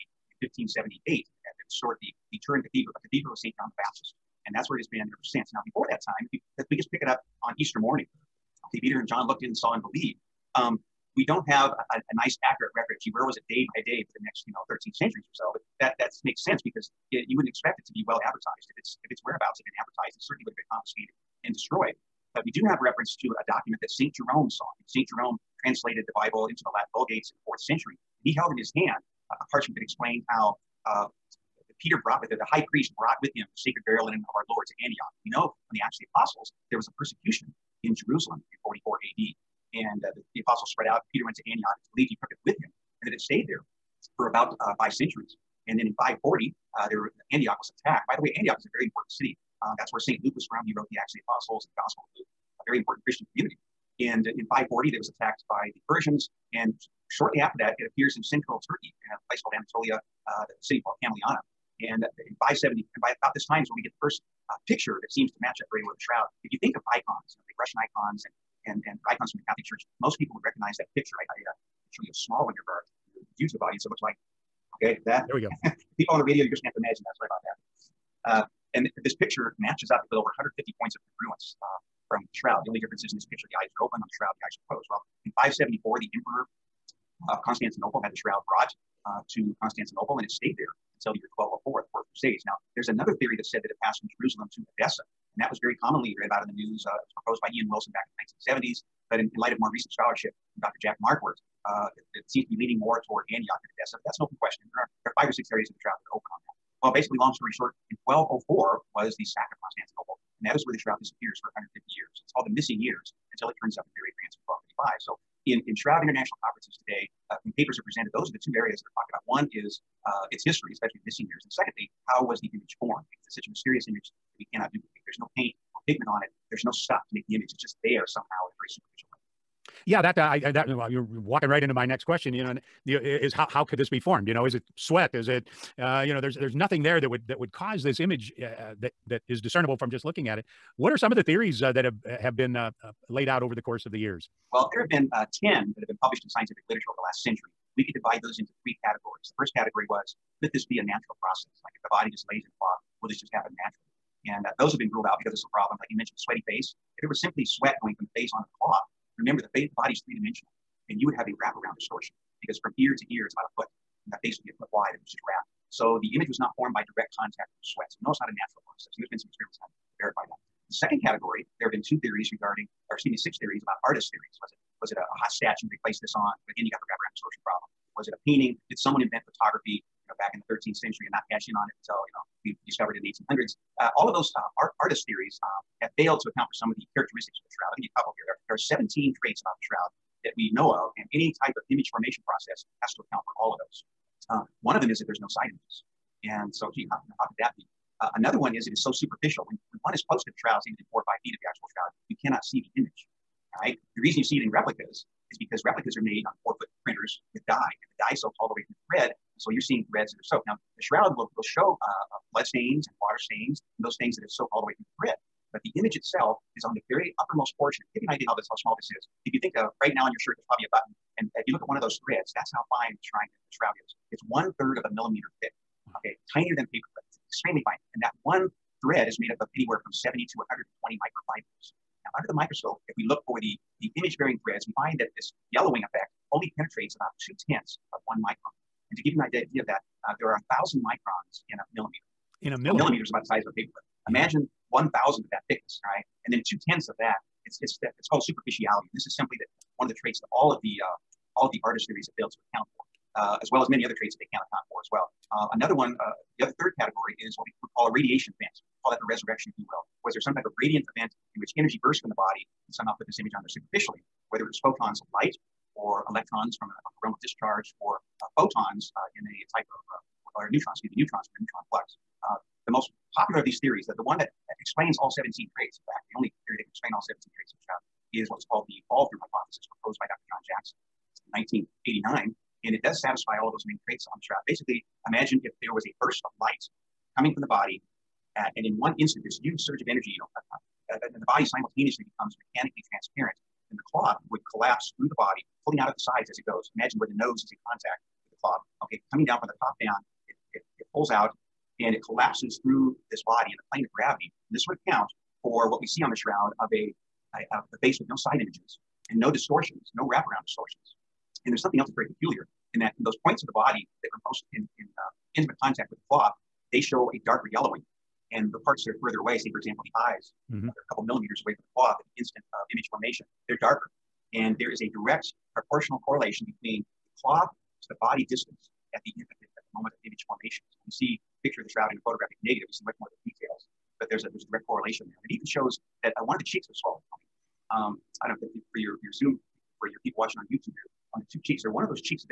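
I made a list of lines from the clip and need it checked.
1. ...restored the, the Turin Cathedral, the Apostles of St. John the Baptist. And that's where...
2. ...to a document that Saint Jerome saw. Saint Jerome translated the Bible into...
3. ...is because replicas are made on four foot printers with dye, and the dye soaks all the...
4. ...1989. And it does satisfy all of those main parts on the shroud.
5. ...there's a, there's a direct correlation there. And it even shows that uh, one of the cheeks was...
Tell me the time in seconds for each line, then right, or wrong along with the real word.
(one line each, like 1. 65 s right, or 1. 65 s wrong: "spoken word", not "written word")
1. 1 s wrong: "Cathedral", not "Apostles"
2. 23 s right
3. 205 s right
4. 281 s wrong: "traits", not "parts"
5. 334 s right.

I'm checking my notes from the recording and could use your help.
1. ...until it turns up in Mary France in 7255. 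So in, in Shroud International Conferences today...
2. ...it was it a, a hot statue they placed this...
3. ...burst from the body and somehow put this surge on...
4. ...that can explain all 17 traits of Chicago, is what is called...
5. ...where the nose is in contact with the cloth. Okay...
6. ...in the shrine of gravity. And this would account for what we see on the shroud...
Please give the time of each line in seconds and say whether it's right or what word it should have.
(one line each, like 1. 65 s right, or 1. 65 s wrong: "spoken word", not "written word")
1. 113 s wrong: "1255", not "7255"
2. 174 s right
3. 261 s wrong: "image", not "surge"
4. 276 s right
5. 296 s right
6. 303 s wrong: "plane", not "shrine".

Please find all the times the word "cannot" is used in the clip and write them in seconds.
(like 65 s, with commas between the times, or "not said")
124 s, 202 s.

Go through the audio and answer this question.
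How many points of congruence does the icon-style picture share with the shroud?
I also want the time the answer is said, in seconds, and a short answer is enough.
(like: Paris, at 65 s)
over 150, at 80 s.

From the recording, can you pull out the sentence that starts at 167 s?
So we know it's not a natural process.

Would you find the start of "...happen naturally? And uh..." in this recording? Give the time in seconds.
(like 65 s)
153 s.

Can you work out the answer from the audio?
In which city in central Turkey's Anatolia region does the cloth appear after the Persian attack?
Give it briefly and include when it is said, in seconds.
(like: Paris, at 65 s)
Camuliana, at 61 s.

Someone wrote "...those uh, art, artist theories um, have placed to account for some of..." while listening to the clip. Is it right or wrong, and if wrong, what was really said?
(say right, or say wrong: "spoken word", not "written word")
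wrong: "failed", not "placed".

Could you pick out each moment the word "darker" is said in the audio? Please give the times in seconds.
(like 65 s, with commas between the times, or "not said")
317 s, 323 s.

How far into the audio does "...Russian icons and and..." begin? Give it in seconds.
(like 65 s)
67 s.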